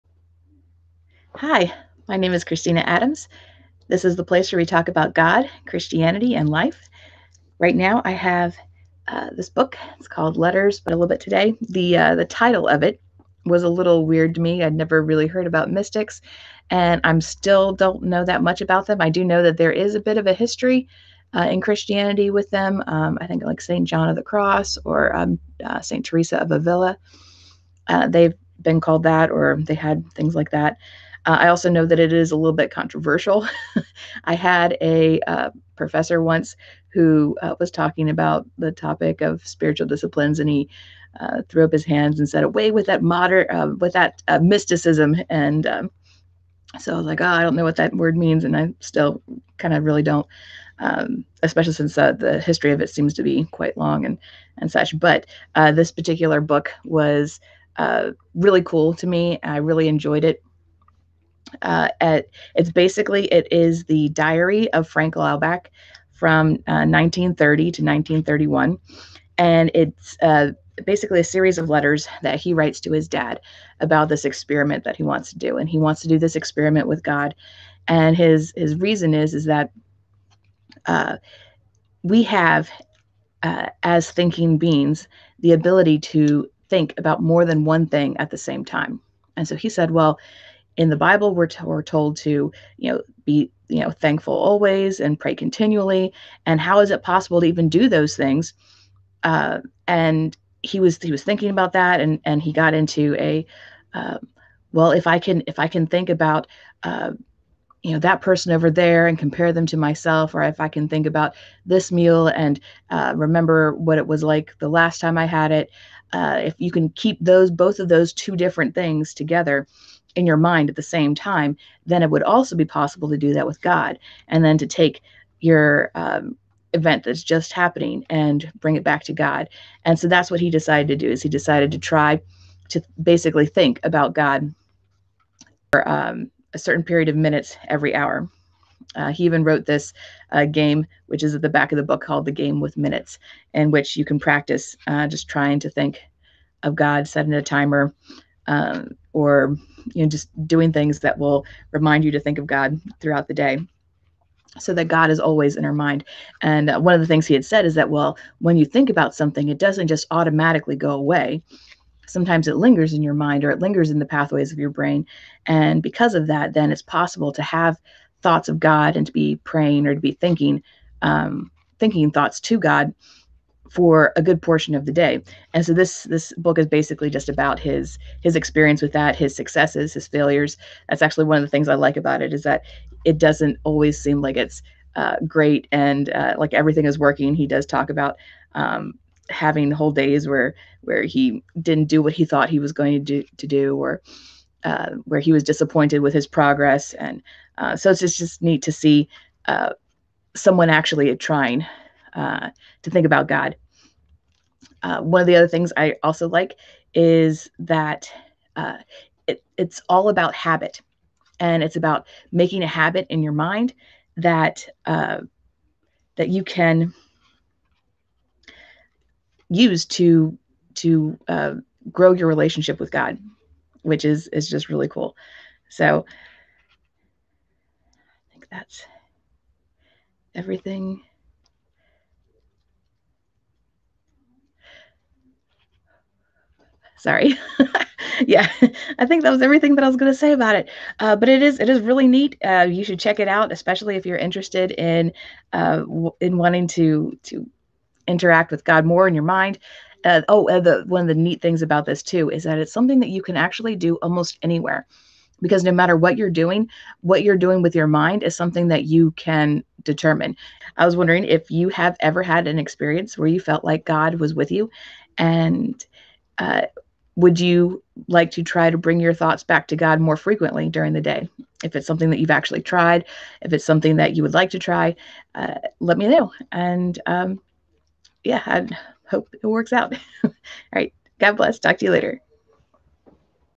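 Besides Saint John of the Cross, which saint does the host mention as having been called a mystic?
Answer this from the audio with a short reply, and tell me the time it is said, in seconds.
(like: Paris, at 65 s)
Saint Teresa of Avila, at 25 s.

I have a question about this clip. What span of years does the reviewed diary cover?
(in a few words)
1930 to 1931.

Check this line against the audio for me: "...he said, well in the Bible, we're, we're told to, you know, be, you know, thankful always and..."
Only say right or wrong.
right.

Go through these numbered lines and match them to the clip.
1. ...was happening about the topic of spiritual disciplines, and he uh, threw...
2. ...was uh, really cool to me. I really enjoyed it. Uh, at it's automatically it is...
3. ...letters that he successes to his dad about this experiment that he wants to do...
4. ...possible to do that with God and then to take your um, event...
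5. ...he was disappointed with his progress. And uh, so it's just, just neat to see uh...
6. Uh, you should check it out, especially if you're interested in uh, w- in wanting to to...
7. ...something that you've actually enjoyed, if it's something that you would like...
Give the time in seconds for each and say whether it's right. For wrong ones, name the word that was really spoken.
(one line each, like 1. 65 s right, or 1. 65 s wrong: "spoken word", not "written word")
1. 37 s wrong: "talking", not "happening"
2. 56 s wrong: "basically", not "automatically"
3. 71 s wrong: "writes", not "successes"
4. 122 s right
5. 195 s right
6. 242 s right
7. 271 s wrong: "tried", not "enjoyed".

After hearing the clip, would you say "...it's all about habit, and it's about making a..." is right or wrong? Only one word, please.
right.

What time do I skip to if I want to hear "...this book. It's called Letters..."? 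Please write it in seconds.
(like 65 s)
9 s.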